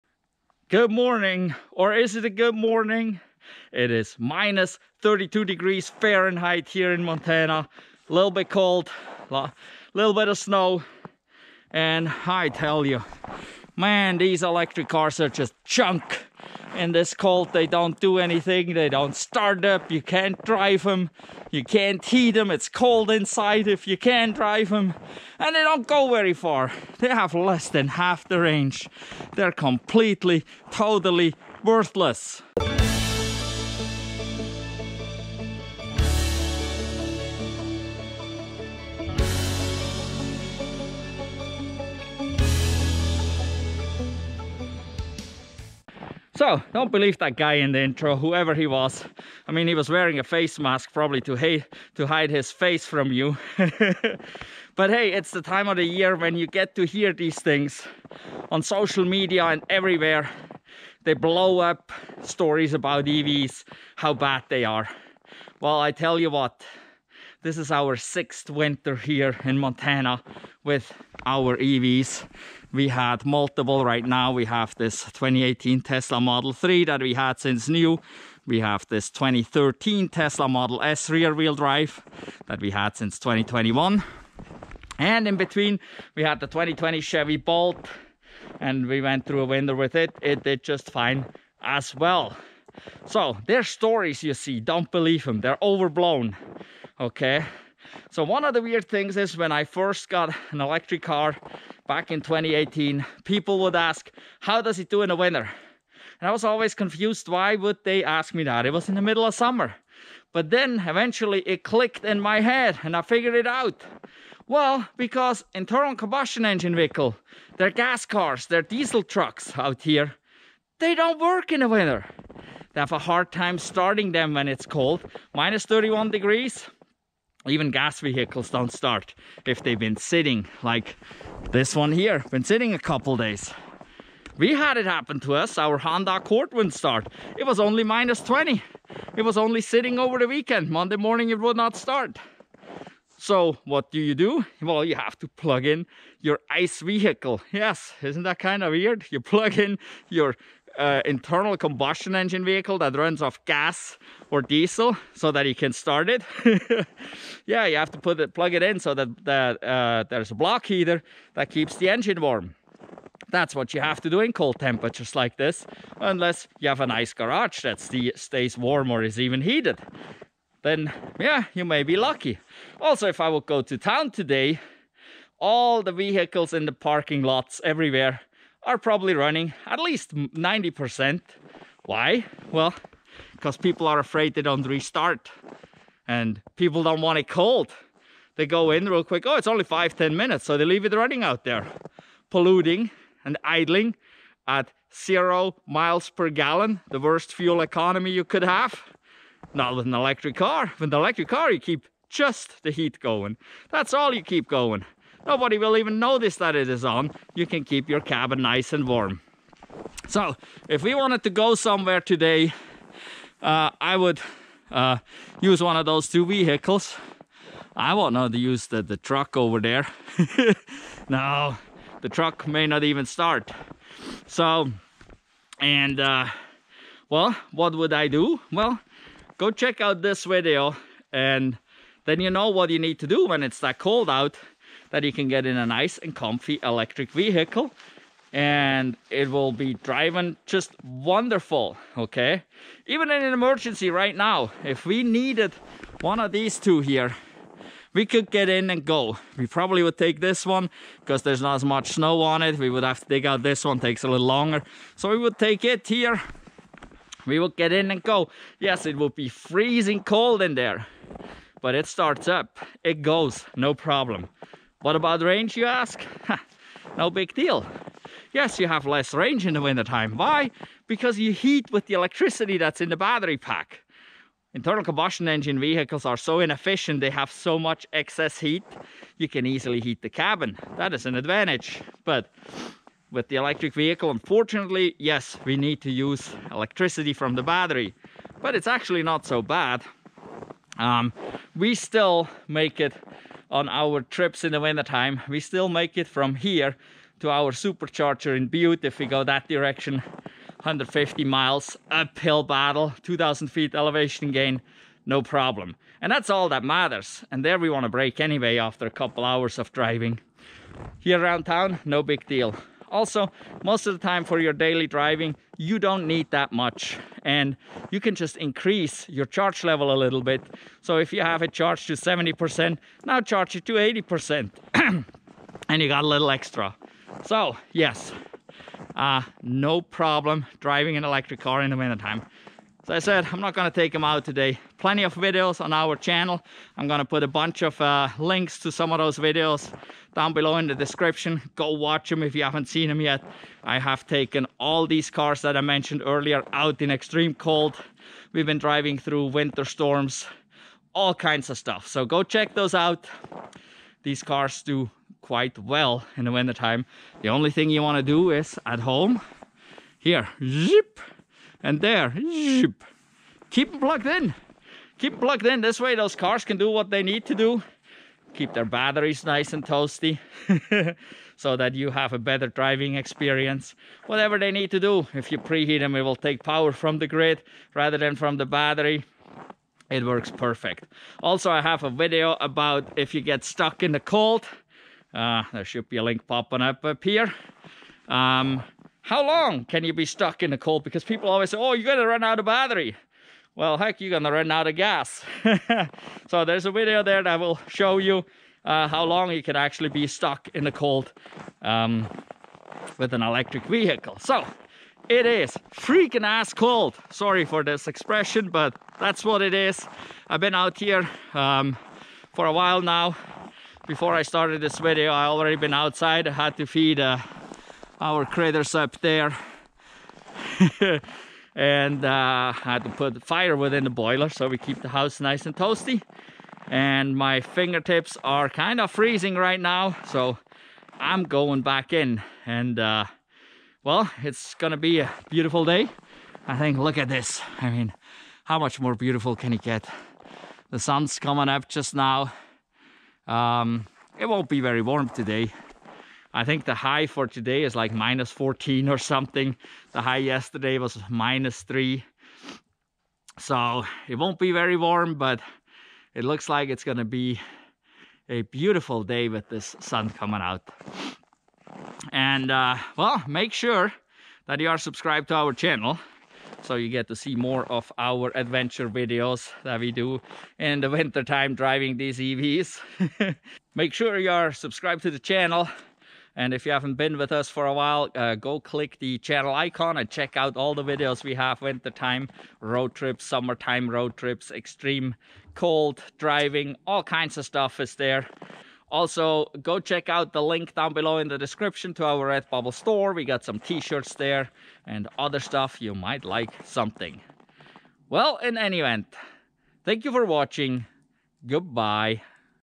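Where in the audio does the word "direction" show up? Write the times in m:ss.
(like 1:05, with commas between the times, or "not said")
4:59.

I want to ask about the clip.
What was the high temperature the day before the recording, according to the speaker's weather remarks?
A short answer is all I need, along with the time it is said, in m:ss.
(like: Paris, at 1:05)
-3, at 7:31.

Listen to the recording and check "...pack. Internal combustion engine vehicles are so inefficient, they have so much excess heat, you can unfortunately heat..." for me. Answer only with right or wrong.
wrong.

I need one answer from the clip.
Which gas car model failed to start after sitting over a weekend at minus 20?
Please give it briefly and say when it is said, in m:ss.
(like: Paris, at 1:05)
Honda Accord, at 2:15.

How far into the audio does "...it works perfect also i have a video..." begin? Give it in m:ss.
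6:19.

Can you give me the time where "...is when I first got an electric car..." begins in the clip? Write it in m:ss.
1:39.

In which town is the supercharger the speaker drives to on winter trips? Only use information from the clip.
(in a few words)
Butte.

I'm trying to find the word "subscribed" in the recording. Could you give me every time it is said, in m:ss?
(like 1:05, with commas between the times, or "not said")
7:44, 7:54.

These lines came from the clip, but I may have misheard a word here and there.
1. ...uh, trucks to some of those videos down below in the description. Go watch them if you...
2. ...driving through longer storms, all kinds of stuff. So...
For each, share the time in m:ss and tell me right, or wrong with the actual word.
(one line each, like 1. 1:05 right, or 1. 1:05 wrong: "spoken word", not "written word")
1. 5:37 wrong: "links", not "trucks"
2. 5:48 wrong: "winter", not "longer".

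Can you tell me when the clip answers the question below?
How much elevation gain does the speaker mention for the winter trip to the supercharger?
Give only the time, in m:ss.
5:03.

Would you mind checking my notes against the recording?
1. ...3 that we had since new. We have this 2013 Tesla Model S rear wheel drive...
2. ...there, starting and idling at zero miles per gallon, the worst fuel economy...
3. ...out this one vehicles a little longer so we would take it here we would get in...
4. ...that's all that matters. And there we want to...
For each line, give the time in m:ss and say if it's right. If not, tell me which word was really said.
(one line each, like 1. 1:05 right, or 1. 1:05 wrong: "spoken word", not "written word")
1. 1:16 right
2. 3:11 wrong: "polluting", not "starting"
3. 4:13 wrong: "takes", not "vehicles"
4. 5:06 right.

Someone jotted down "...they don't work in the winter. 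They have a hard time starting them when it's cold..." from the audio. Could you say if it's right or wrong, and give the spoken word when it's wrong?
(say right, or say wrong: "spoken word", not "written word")
right.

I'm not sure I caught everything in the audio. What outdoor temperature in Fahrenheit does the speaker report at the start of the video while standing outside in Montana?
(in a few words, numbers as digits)
-32.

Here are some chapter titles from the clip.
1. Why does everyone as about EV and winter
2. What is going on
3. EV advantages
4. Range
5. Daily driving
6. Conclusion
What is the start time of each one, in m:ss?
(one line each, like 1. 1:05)
1. 1:37
2. 0:46
3. 3:19
4. 4:23
5. 5:09
6. 5:28.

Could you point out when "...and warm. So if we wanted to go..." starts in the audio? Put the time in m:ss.
3:28.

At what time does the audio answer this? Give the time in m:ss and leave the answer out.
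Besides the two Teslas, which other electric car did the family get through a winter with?
1:27.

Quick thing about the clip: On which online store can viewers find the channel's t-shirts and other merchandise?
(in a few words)
Redbubble.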